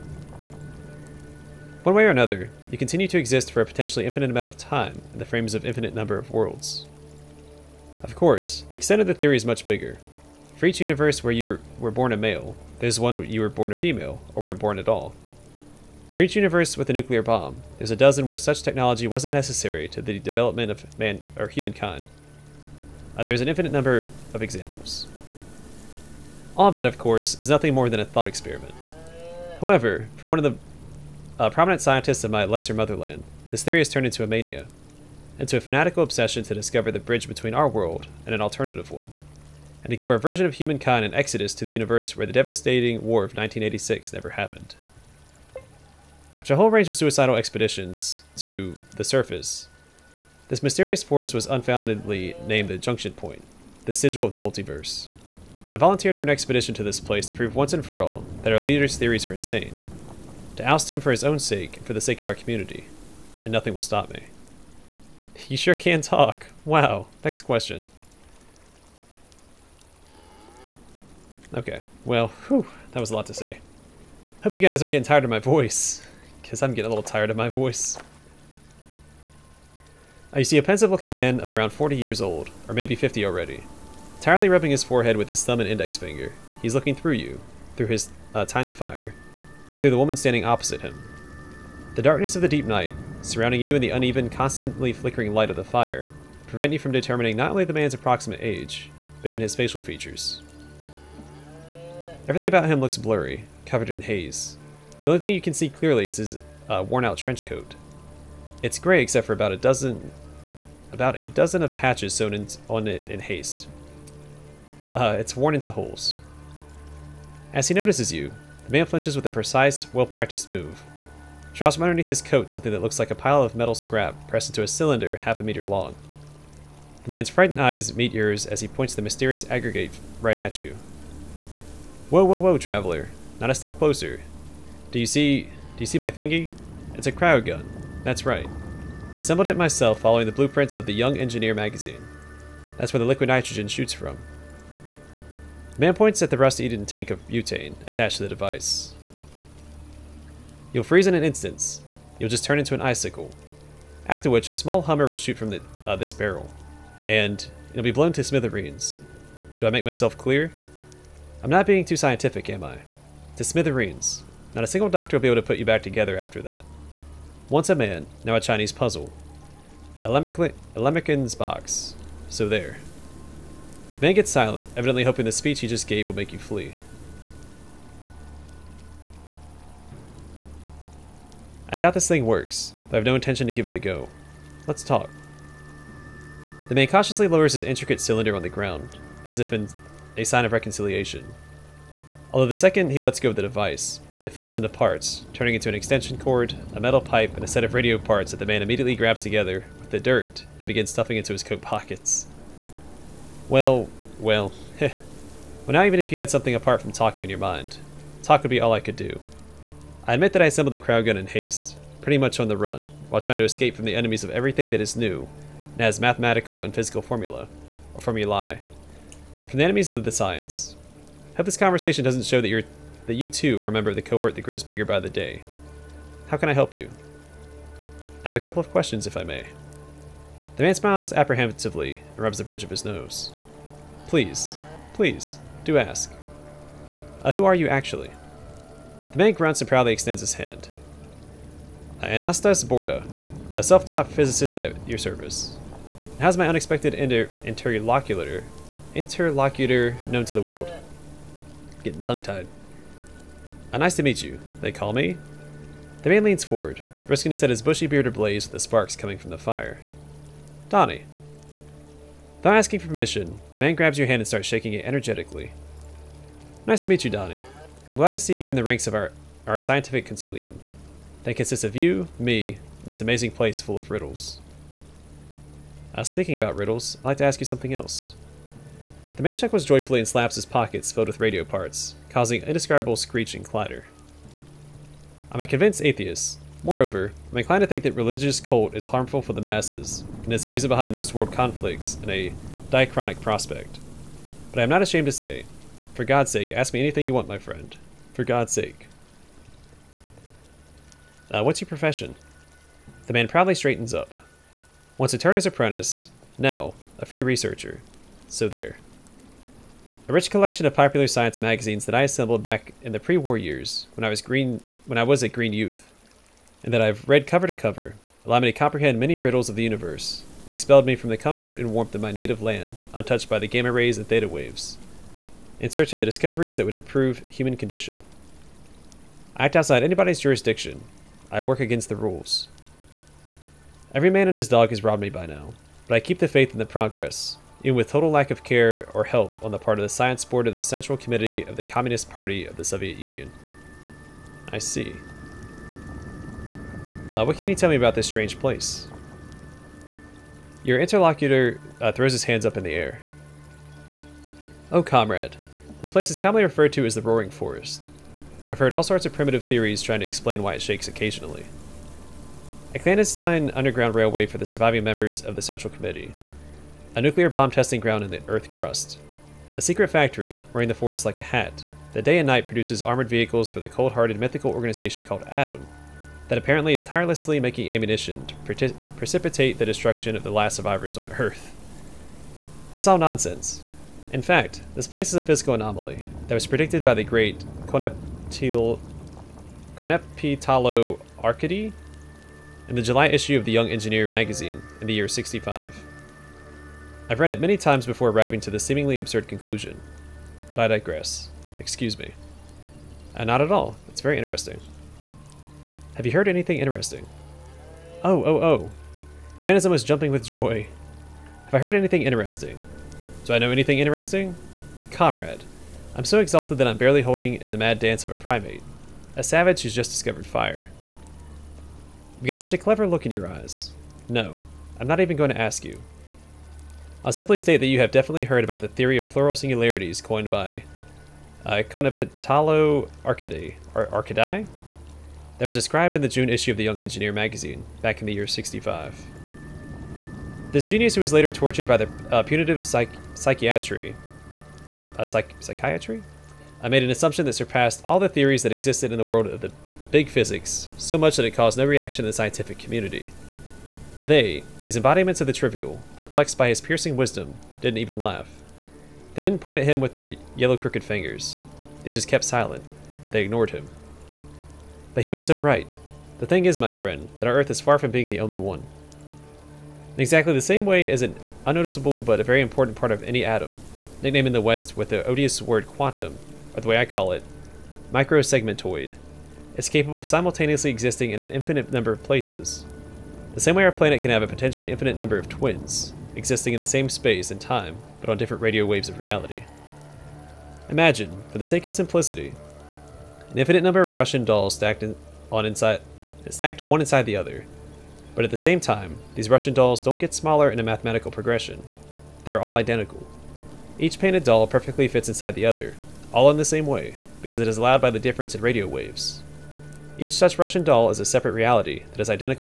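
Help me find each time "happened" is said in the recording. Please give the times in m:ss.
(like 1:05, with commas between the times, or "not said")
0:44.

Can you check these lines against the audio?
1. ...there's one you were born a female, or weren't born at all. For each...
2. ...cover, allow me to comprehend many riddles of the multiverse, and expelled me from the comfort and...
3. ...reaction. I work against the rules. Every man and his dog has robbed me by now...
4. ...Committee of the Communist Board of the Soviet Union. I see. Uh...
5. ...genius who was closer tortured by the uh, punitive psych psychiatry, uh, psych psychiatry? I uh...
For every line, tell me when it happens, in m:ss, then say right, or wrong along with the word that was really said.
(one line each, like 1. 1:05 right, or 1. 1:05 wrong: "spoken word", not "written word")
1. 0:12 right
2. 5:17 wrong: "universe", not "multiverse"
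3. 5:30 wrong: "jurisdiction", not "reaction"
4. 5:40 wrong: "Party", not "Board"
5. 7:20 wrong: "later", not "closer".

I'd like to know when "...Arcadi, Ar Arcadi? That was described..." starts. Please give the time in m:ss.
7:13.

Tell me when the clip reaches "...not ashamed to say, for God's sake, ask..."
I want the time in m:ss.
4:54.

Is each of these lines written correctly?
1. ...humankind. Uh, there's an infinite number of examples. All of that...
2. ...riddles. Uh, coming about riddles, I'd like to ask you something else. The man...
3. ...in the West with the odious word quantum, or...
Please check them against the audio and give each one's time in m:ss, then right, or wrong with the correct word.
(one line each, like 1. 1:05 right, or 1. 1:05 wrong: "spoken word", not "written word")
1. 0:21 right
2. 4:33 wrong: "speaking", not "coming"
3. 7:54 right.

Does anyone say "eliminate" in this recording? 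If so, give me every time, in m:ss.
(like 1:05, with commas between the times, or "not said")
not said.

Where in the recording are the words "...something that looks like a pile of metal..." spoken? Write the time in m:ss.
2:02.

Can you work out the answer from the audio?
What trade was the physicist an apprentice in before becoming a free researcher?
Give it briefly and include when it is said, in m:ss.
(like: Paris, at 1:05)
turner, at 5:05.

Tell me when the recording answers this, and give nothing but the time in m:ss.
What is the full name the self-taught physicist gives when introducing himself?
4:02.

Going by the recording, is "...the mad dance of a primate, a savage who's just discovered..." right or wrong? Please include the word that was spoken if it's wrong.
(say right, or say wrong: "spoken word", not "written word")
right.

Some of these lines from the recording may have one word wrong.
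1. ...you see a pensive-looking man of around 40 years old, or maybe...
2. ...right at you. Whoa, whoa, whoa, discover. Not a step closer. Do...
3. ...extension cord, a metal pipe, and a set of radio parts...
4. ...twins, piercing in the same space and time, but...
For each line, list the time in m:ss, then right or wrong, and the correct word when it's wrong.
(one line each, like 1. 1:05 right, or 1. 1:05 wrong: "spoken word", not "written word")
1. 1:20 right
2. 2:10 wrong: "traveler", not "discover"
3. 3:15 right
4. 8:05 wrong: "existing", not "piercing".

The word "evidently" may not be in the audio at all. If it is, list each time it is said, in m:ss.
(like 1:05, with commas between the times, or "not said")
2:54.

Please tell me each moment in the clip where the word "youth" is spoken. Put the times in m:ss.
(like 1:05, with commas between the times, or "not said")
5:15.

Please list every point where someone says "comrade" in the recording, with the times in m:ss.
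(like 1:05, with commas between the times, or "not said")
5:54, 6:54.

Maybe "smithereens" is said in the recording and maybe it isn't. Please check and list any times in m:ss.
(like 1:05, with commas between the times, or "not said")
2:38, 2:43.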